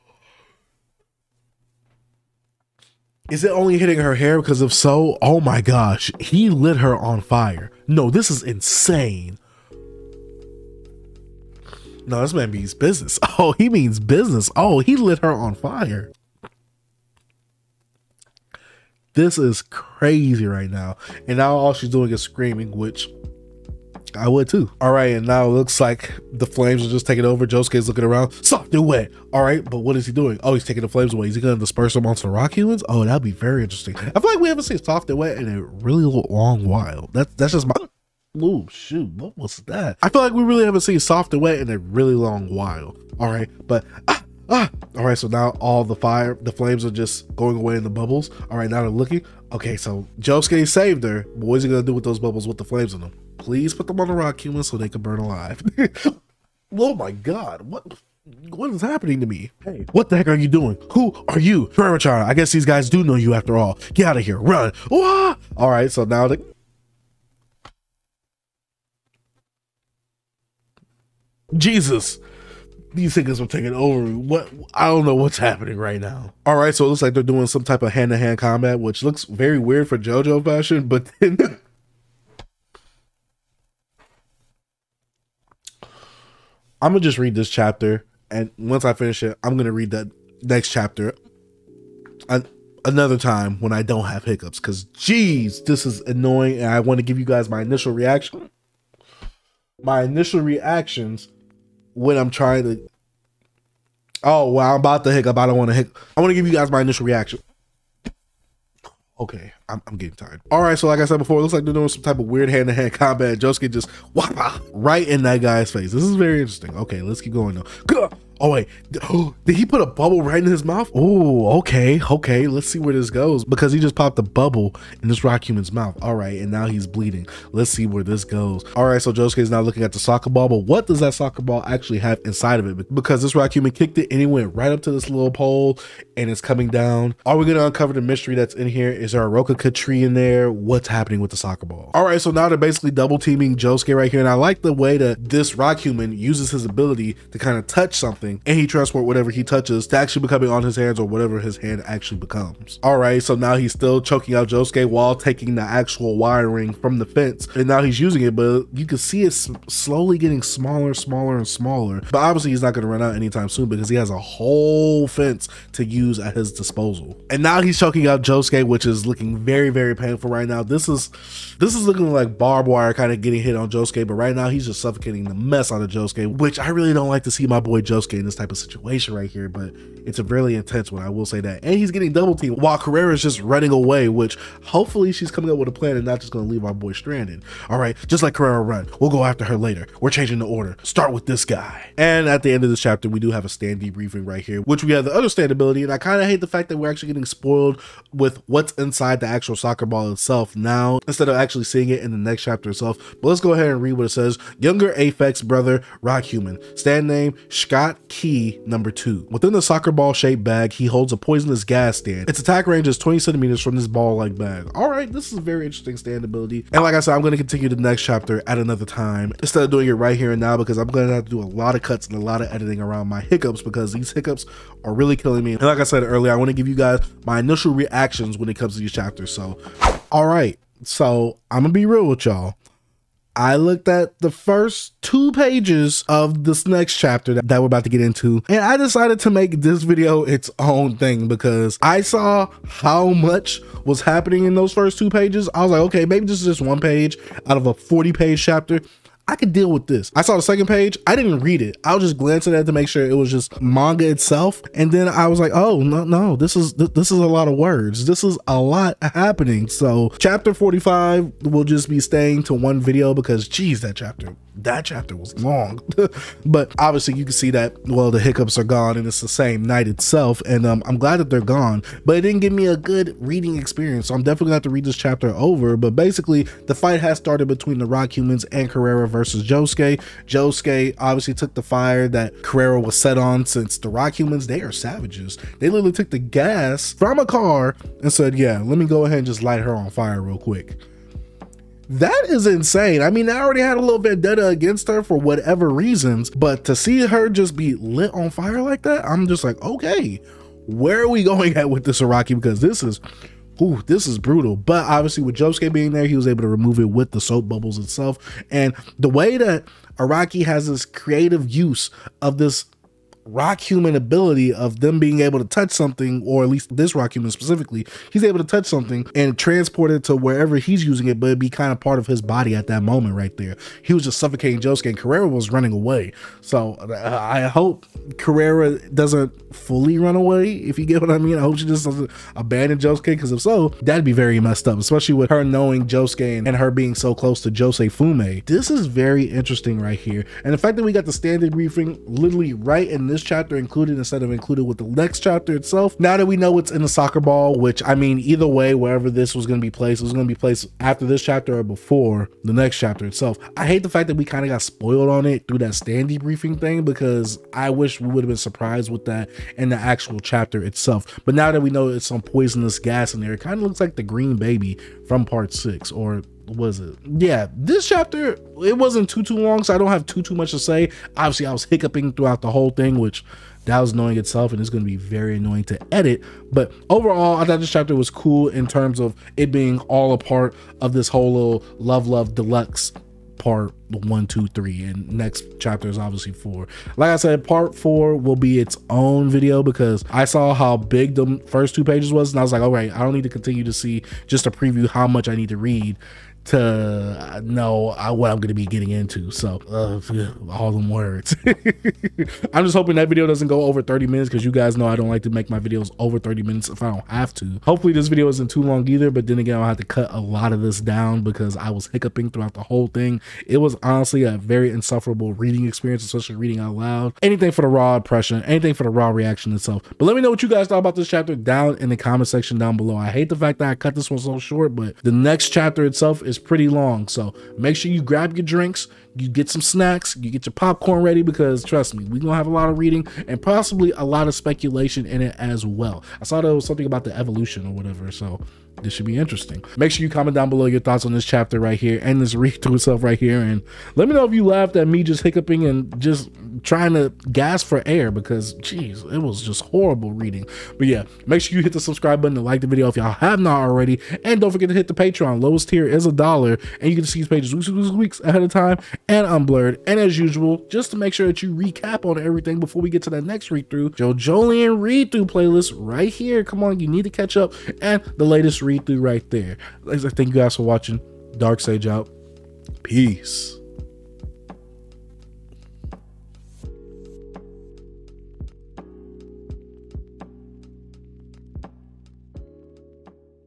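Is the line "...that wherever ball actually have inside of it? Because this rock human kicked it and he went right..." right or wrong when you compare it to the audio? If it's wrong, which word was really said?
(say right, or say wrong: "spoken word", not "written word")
wrong: "soccer", not "wherever".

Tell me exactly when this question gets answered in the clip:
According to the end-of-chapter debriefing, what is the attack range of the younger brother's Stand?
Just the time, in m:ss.
3:32.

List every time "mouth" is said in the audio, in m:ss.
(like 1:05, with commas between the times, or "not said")
2:00, 2:05.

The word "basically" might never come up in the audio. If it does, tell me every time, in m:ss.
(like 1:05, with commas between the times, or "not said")
2:22, 4:35.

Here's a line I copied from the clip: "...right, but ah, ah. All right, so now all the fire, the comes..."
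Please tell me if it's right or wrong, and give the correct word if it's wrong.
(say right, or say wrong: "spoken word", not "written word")
wrong: "flames", not "comes".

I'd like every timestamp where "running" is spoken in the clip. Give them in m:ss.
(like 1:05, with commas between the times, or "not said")
3:03, 5:25.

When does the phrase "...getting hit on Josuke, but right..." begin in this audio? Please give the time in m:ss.
2:53.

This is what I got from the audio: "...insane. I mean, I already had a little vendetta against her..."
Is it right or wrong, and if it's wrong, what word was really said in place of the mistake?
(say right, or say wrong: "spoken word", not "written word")
right.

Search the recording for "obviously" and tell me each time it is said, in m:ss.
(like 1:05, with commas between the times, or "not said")
2:42, 4:26, 4:40, 5:04, 6:11, 6:25.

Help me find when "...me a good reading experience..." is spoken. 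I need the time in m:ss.
4:32.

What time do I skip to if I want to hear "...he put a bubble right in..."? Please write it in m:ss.
1:59.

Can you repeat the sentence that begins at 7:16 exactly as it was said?
I saw there was something about the evolution or whatever.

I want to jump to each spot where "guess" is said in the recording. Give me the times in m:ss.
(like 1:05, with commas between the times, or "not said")
1:02.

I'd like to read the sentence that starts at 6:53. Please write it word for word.
It was honestly a very insufferable reading experience, especially reading out loud.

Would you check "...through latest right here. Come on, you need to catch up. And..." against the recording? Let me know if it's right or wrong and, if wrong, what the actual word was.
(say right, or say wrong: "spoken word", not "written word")
wrong: "playlist", not "latest".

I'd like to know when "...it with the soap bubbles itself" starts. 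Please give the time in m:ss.
5:06.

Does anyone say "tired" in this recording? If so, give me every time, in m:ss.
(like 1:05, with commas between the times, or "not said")
1:50.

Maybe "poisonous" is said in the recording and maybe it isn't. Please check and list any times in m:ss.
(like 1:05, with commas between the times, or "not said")
3:31, 6:02.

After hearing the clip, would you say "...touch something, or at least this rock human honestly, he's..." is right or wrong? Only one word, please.
wrong.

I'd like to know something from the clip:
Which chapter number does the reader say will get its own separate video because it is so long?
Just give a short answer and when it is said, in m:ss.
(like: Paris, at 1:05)
45, at 4:20.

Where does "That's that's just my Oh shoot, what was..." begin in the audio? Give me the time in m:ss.
0:37.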